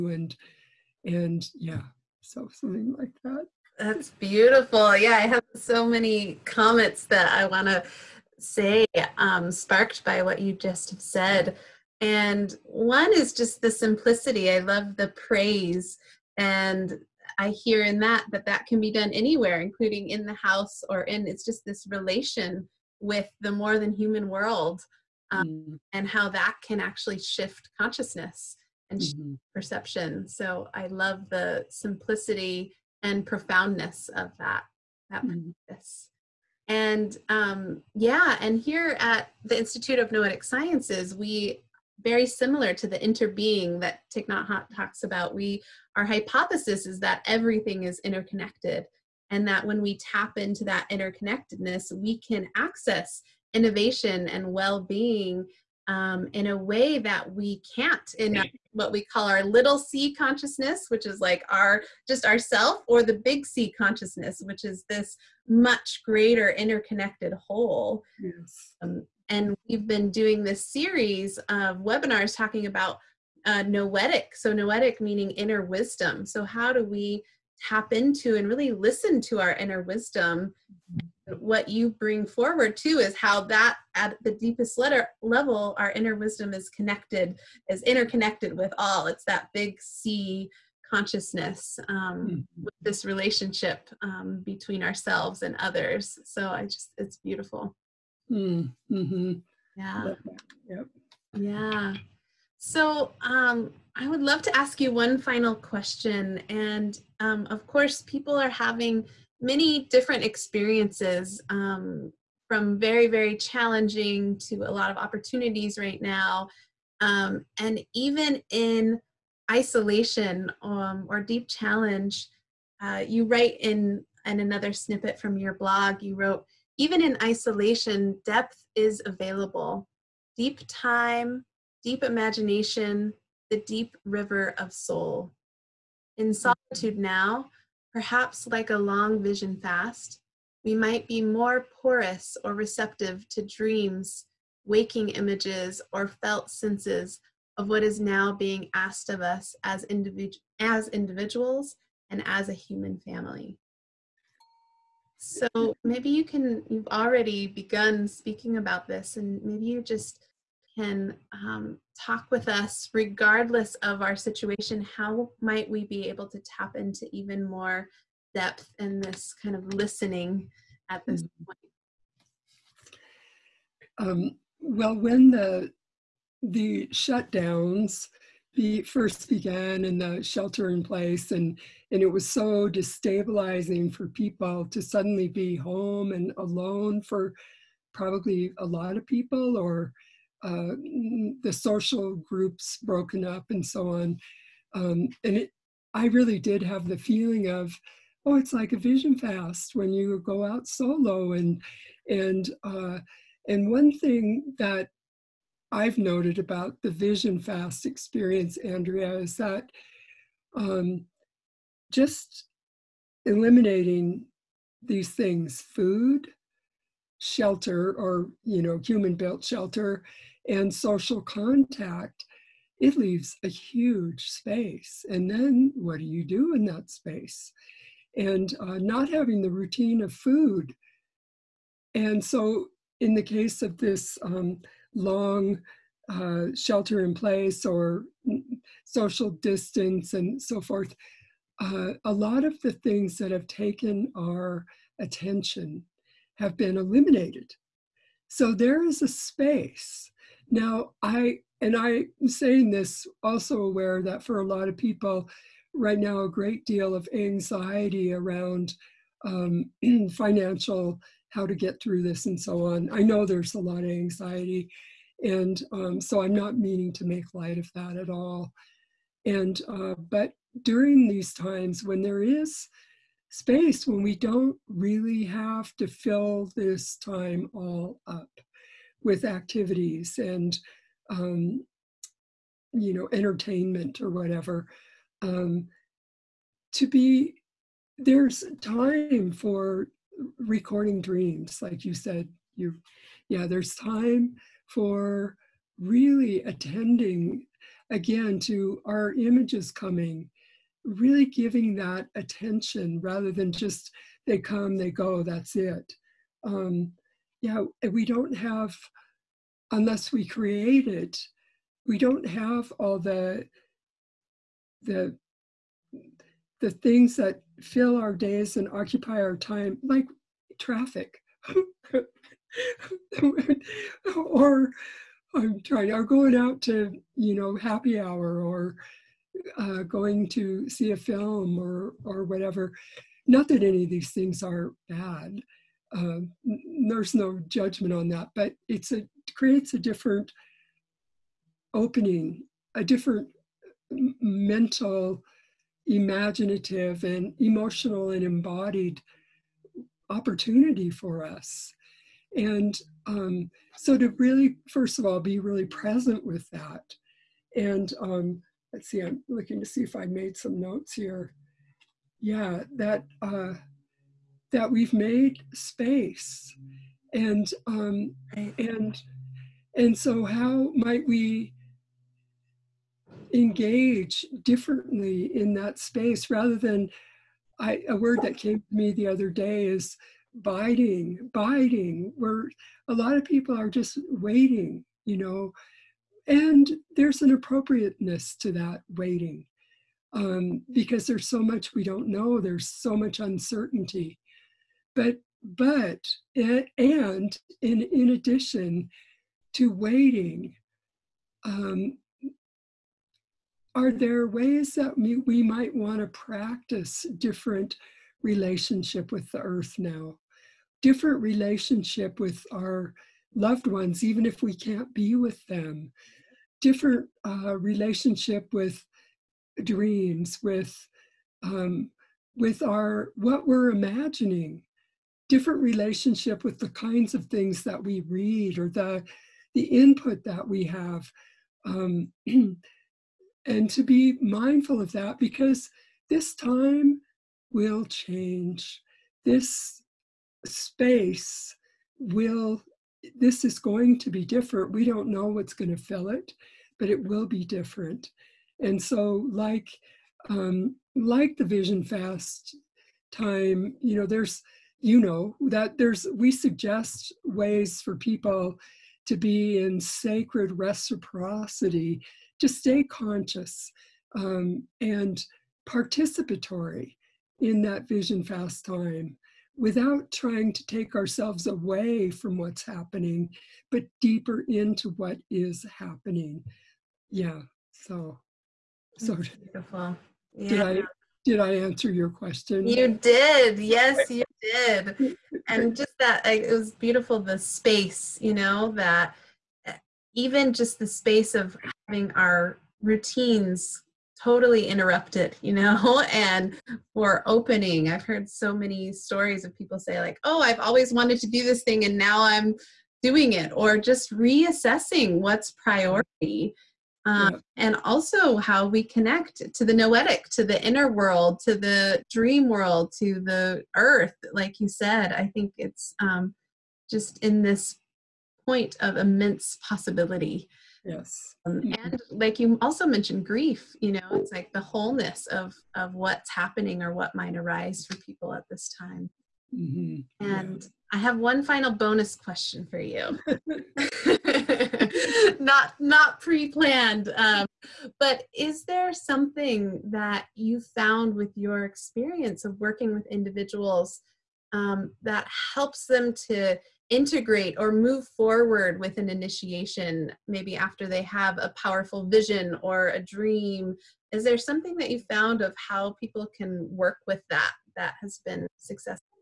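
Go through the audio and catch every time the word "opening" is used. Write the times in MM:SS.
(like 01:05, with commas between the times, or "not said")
05:41, 08:17.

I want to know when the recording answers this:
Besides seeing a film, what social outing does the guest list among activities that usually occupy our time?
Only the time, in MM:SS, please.
05:27.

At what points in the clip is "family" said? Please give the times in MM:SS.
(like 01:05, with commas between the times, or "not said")
02:32.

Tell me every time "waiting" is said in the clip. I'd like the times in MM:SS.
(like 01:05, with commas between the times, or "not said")
06:24, 06:28, 06:39.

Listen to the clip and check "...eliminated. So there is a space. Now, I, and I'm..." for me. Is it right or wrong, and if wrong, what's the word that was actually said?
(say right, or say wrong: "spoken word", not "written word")
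right.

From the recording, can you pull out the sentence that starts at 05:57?
And um, let's see, I'm looking to see if I made some notes here.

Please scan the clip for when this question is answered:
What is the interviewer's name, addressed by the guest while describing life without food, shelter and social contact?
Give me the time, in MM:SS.
03:28.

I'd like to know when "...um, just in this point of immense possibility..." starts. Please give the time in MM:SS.
08:35.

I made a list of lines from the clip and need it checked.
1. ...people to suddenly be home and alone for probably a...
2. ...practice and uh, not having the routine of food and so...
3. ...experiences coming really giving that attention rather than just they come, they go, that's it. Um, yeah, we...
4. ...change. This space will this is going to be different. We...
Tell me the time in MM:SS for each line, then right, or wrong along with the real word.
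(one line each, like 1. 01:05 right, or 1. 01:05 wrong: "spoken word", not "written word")
1. 03:04 right
2. 03:46 wrong: "space", not "practice"
3. 04:59 wrong: "images", not "experiences"
4. 07:17 right.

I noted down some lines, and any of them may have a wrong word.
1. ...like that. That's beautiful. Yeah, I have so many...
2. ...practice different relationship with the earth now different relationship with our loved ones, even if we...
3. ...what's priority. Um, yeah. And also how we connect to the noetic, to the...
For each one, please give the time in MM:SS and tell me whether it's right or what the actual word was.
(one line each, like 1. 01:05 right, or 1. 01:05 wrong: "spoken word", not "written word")
1. 00:02 right
2. 06:46 right
3. 08:25 right.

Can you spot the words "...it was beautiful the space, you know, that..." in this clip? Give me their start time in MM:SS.
08:06.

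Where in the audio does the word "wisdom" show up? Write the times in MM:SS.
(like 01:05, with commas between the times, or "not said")
01:15, 01:19, 01:26.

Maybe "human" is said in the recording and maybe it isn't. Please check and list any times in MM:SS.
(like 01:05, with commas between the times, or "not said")
00:23, 02:32, 03:38.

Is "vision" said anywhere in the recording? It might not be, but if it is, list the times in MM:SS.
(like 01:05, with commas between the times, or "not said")
02:19, 03:18, 03:26, 07:31, 07:47, 09:12.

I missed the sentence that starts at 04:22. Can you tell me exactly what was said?
I know there's a lot of anxiety.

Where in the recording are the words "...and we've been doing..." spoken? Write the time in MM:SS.
01:09.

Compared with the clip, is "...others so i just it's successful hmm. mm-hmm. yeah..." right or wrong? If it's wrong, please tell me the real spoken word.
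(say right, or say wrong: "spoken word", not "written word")
wrong: "beautiful", not "successful".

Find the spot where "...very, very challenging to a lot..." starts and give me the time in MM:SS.
01:52.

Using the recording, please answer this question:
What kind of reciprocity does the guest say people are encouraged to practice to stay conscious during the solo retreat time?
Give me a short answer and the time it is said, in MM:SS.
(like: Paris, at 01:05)
sacred reciprocity, at 07:39.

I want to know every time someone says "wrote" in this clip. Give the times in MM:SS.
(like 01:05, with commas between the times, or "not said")
02:06.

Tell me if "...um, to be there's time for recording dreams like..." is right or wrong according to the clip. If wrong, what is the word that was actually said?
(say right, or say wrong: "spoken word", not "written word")
right.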